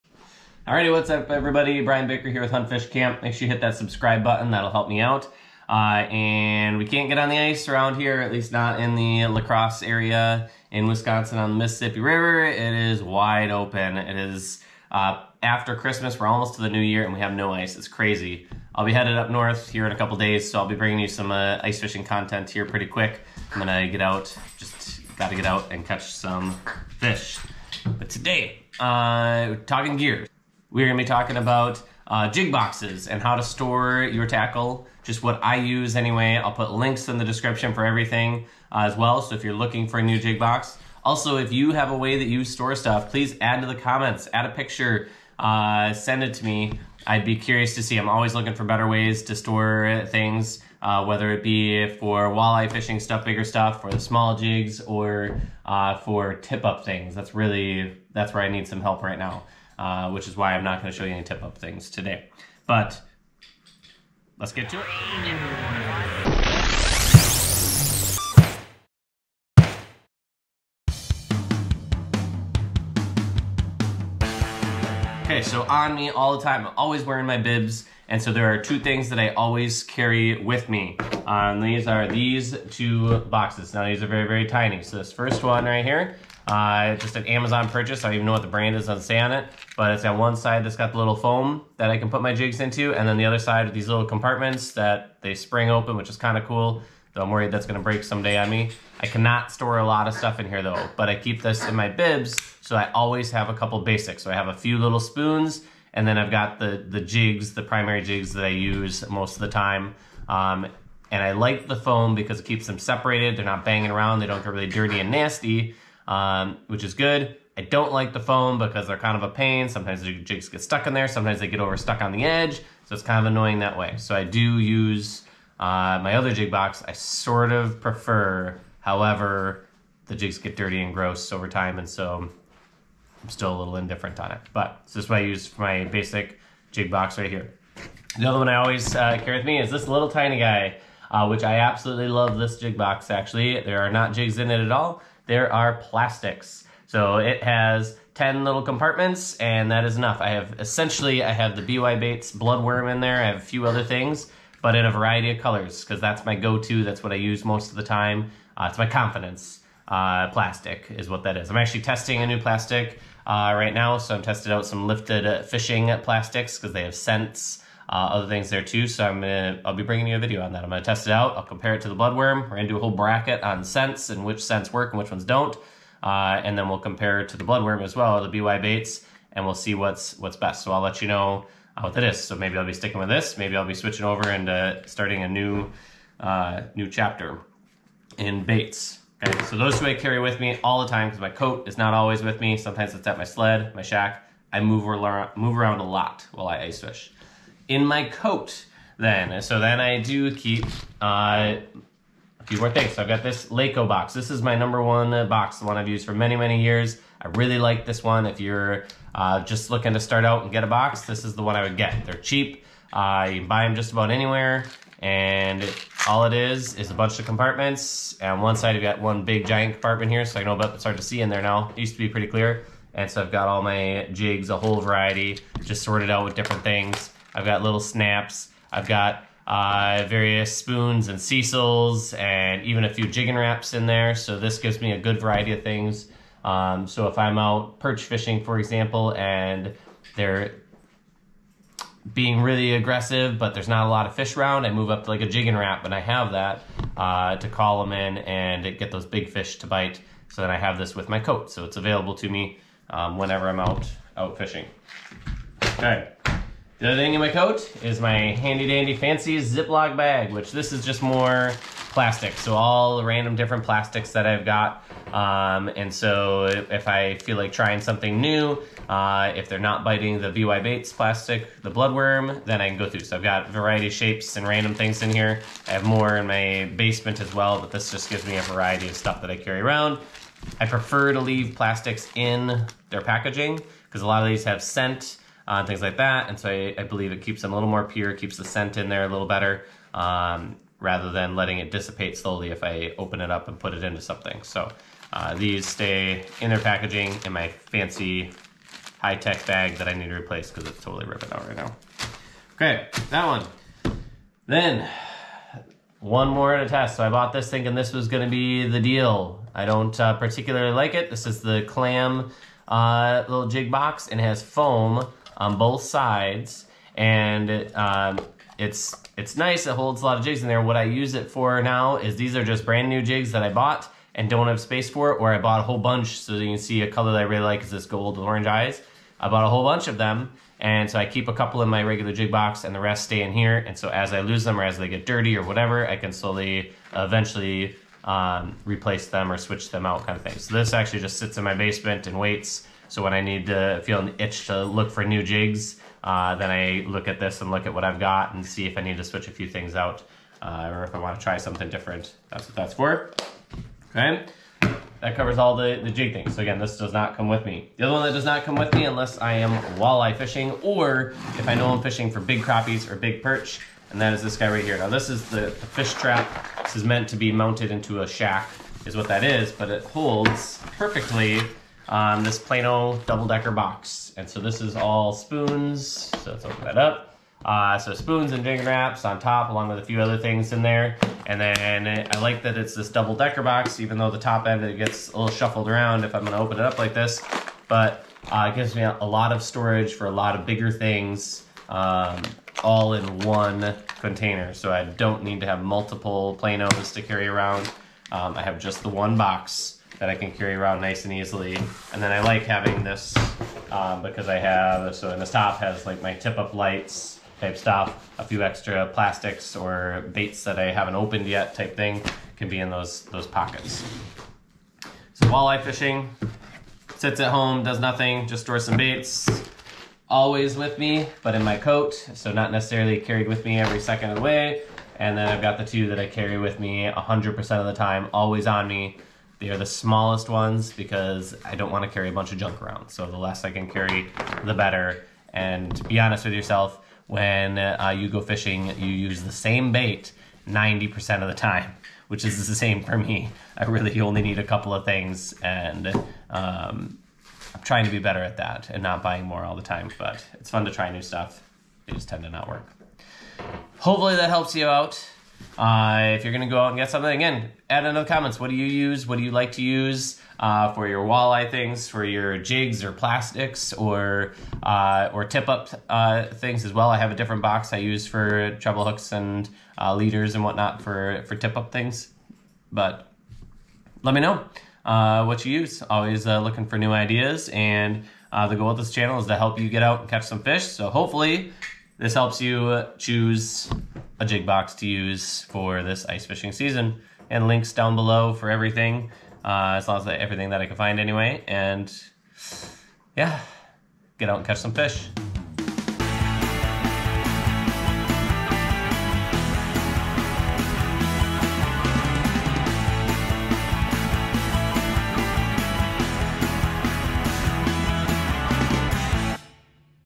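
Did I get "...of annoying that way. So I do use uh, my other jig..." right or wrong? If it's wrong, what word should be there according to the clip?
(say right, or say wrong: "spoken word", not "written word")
right.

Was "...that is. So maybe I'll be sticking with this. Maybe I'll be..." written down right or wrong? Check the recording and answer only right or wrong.
right.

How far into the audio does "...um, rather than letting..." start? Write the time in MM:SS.
04:49.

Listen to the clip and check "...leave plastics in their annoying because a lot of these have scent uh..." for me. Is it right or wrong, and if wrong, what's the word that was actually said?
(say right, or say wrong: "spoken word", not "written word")
wrong: "packaging", not "annoying".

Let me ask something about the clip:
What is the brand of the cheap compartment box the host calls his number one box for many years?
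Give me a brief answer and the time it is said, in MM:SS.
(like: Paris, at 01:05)
Lakco, at 03:23.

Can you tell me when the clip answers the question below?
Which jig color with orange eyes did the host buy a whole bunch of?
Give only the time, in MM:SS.
05:27.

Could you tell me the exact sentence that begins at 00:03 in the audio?
Make sure you hit that subscribe button, that'll help me out.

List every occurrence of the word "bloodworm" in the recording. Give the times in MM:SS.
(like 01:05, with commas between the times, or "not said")
02:32, 02:51, 02:57, 04:31.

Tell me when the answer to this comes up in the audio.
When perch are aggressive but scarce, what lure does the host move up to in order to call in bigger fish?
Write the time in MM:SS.
04:05.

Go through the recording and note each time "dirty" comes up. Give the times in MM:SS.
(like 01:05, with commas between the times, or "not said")
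01:54, 02:10, 05:35.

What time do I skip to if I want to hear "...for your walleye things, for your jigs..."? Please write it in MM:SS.
07:40.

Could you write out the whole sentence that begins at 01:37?
Though I'm worried that's gonna break someday on me.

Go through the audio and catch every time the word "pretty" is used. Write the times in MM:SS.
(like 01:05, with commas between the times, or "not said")
00:22, 03:42.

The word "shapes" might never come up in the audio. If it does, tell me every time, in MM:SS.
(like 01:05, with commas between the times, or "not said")
04:33.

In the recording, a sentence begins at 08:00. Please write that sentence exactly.
So hopefully this helps you choose a jig box to use for this ice fishing season.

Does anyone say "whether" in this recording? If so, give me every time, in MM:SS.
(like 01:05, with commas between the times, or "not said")
00:51.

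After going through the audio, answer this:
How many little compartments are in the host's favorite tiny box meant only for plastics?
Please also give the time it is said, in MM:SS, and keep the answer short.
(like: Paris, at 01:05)
10, at 02:28.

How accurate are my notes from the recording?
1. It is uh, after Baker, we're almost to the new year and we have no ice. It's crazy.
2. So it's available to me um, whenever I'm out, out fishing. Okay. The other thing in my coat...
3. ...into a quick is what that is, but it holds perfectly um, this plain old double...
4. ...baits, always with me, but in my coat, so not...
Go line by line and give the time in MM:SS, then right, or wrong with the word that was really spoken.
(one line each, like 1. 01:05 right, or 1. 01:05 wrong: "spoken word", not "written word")
1. 00:13 wrong: "Christmas", not "Baker"
2. 04:11 right
3. 06:07 wrong: "shack", not "quick"
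4. 06:58 right.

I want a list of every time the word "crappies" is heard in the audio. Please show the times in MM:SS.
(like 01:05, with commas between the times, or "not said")
06:02.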